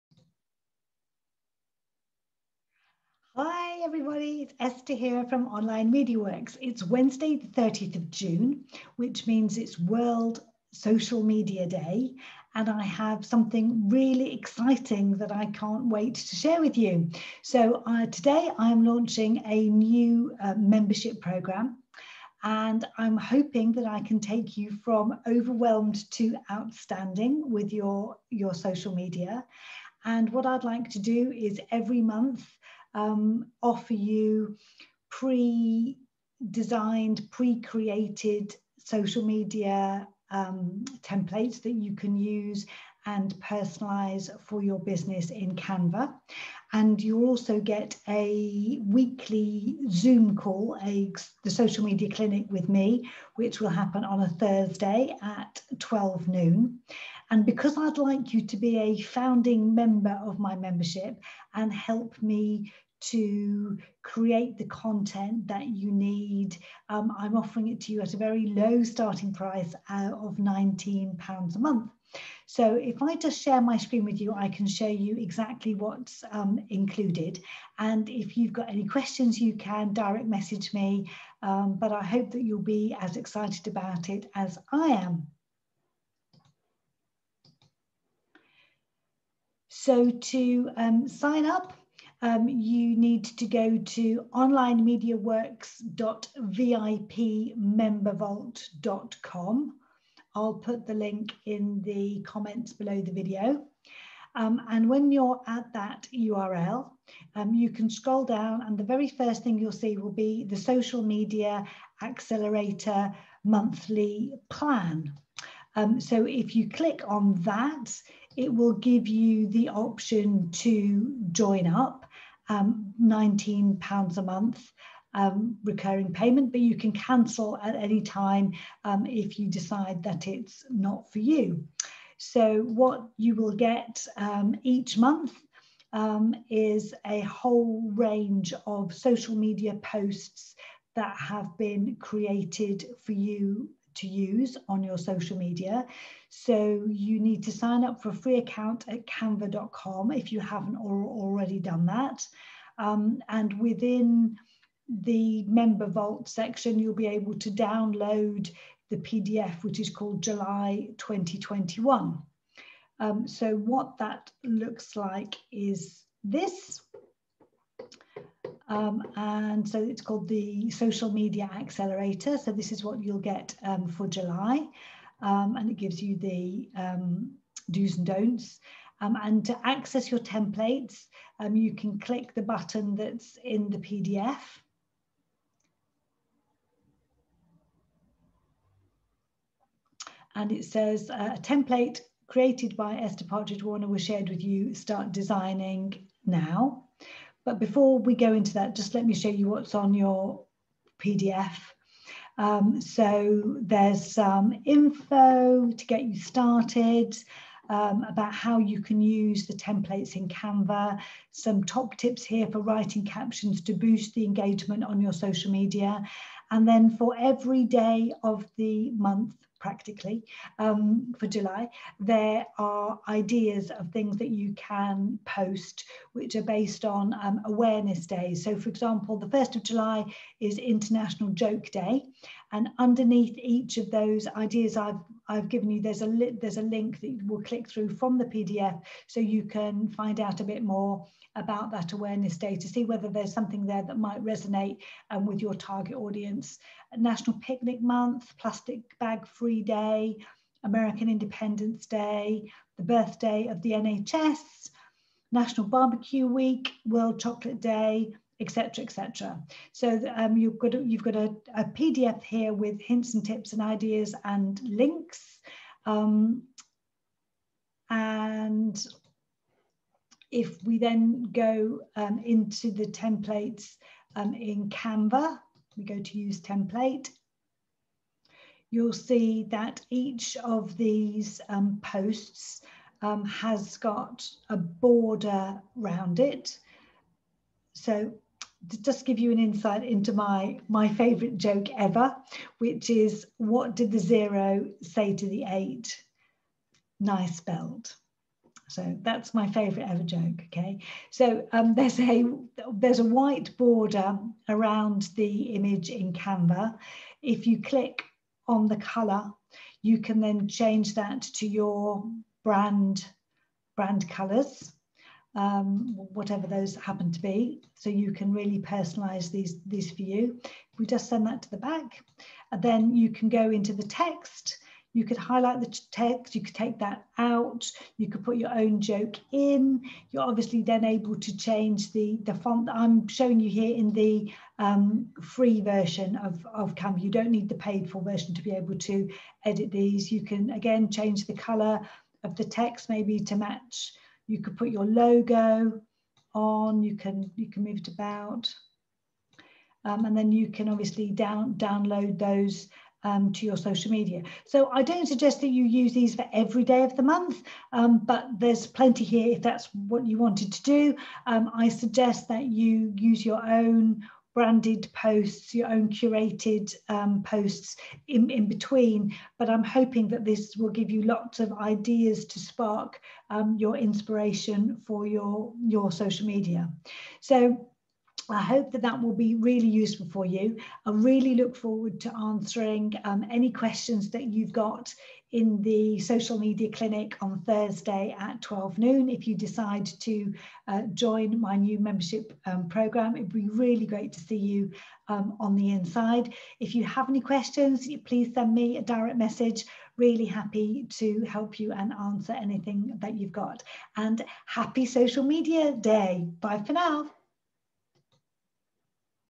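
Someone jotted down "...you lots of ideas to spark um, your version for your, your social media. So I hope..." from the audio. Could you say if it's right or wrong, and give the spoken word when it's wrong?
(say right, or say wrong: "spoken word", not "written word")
wrong: "inspiration", not "version".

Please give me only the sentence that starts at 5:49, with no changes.
Um, and then you can obviously down, download those um, to your social media.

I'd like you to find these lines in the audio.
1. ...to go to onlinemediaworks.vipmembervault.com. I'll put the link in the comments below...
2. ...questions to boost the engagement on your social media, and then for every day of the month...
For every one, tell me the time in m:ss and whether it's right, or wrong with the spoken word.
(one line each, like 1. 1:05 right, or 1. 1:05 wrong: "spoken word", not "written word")
1. 1:33 right
2. 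3:33 wrong: "captions", not "questions".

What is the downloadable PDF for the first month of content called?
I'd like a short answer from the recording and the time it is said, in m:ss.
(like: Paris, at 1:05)
July 2021, at 2:40.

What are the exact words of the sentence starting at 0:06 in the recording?
It's Wednesday, the 30th of June, which means it's World Social Media Day.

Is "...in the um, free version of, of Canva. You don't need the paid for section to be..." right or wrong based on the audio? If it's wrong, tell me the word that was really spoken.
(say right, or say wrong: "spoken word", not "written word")
wrong: "version", not "section".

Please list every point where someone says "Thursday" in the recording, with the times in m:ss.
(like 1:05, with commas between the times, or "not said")
0:54, 6:27.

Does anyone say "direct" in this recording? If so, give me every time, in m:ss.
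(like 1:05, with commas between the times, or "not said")
1:19, 6:38.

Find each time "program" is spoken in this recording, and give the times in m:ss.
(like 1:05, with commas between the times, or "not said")
0:21, 6:32.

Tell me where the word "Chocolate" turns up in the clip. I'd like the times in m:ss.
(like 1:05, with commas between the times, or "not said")
4:17.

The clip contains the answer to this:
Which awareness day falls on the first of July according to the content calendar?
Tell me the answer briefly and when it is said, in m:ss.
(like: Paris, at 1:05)
International Joke Day, at 3:50.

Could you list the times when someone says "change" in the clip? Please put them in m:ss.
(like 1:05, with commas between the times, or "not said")
5:10, 5:31, 5:40.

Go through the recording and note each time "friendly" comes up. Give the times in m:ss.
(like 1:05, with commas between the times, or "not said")
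not said.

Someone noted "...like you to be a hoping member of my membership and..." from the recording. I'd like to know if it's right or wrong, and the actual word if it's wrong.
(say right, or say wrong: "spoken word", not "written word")
wrong: "founding", not "hoping".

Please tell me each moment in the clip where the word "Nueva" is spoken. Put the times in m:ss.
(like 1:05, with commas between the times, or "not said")
not said.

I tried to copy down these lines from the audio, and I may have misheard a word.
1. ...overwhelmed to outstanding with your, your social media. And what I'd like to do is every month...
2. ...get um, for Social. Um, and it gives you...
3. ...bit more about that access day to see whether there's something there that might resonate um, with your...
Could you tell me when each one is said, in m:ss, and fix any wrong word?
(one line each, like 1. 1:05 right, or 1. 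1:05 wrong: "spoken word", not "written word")
1. 0:25 right
2. 2:53 wrong: "July", not "Social"
3. 4:00 wrong: "awareness", not "access".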